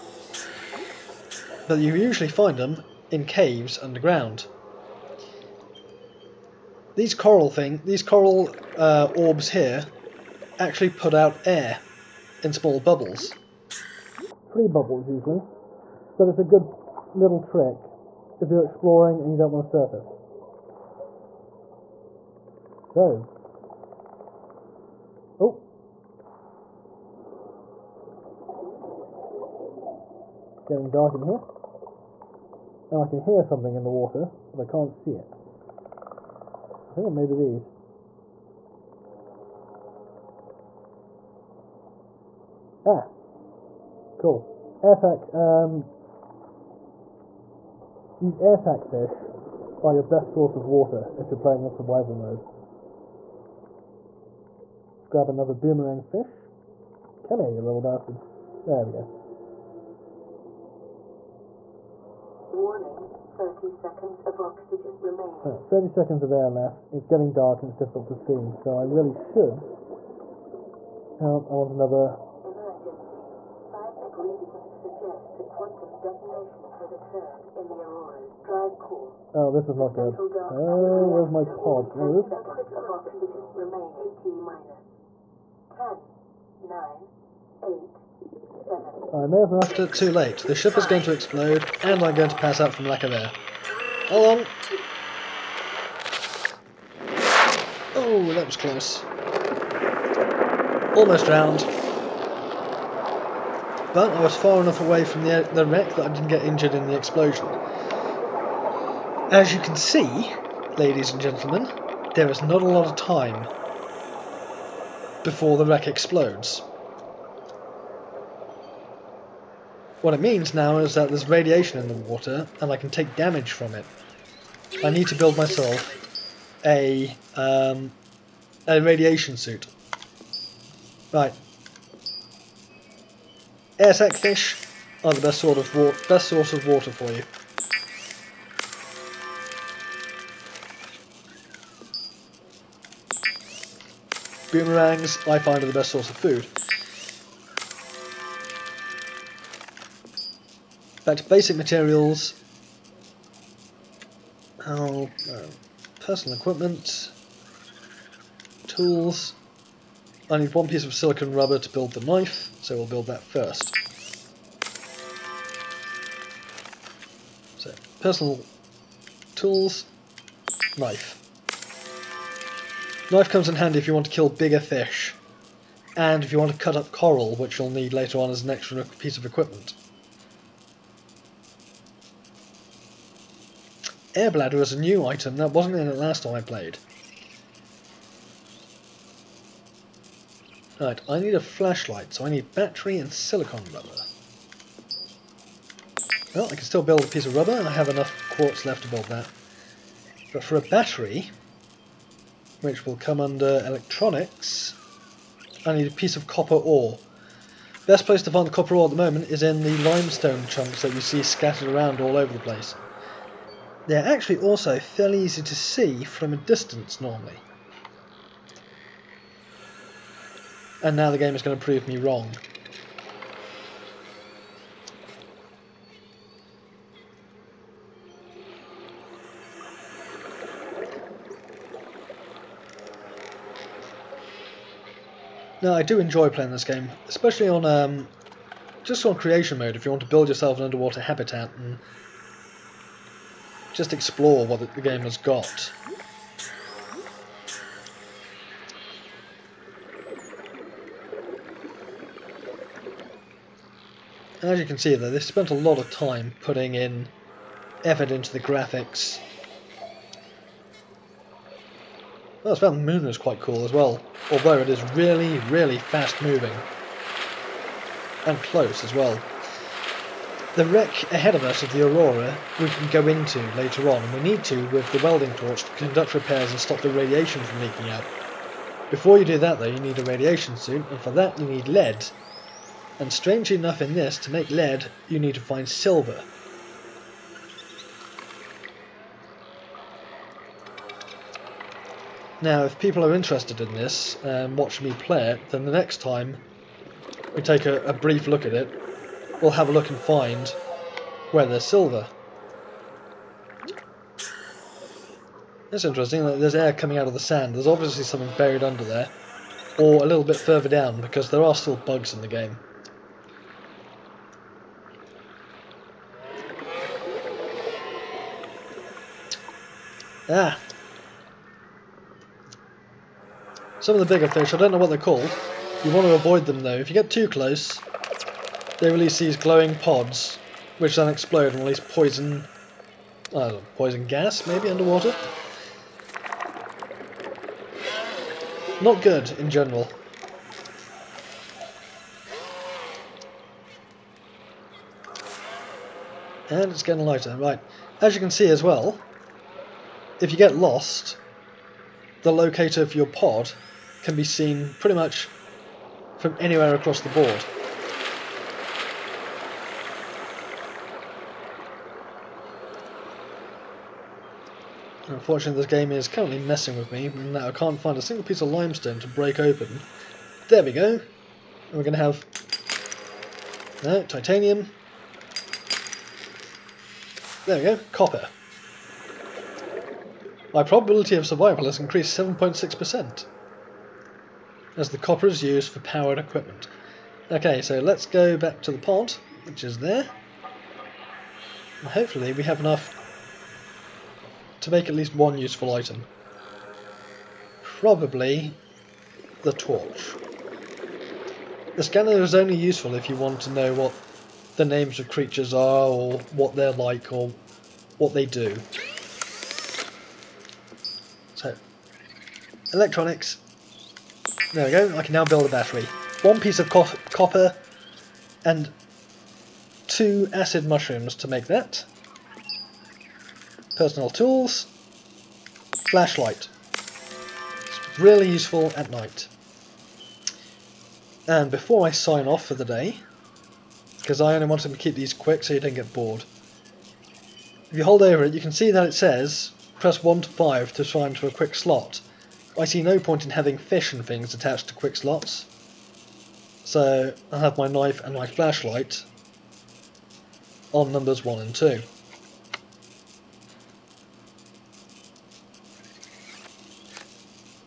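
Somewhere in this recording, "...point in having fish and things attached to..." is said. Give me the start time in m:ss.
7:22.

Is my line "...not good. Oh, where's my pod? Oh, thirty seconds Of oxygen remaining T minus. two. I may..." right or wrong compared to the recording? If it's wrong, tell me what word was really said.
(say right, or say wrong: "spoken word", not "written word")
wrong: "seven", not "two".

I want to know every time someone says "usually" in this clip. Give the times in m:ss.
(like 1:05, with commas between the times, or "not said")
0:01, 0:15.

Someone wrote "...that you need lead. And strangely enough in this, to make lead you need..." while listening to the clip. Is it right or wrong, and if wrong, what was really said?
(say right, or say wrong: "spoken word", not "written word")
right.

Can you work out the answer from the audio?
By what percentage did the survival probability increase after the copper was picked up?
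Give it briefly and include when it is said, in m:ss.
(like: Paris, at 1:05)
7.6%, at 6:22.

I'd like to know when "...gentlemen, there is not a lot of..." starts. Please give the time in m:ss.
1:51.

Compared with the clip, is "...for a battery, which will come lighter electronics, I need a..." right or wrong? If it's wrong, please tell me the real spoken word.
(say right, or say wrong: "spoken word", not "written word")
wrong: "under", not "lighter".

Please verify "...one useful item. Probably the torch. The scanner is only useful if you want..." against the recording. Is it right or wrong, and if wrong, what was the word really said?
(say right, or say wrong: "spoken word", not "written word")
right.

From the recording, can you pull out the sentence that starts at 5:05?
It's interesting that there's air coming out of the sand.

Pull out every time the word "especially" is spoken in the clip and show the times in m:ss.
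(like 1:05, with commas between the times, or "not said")
3:57.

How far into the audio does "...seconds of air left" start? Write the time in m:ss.
1:05.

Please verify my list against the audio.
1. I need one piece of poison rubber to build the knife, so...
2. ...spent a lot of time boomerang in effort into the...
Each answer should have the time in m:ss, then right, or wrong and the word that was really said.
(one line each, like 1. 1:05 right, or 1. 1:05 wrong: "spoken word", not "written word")
1. 2:40 wrong: "silicon", not "poison"
2. 4:15 wrong: "putting", not "boomerang".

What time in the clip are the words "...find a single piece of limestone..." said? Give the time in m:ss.
6:07.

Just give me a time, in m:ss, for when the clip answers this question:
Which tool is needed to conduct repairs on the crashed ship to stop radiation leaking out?
4:35.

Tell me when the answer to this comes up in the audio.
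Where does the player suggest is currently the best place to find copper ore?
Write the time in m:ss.
3:29.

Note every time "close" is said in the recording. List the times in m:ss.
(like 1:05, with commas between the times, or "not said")
1:38, 4:28, 5:27.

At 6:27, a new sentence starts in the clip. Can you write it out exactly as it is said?
Okay, so let's go back to the pond, which is there.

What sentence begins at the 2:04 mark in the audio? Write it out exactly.
I need to build myself a, um, a radiation suit.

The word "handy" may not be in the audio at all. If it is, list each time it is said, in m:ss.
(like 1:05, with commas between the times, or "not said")
2:53.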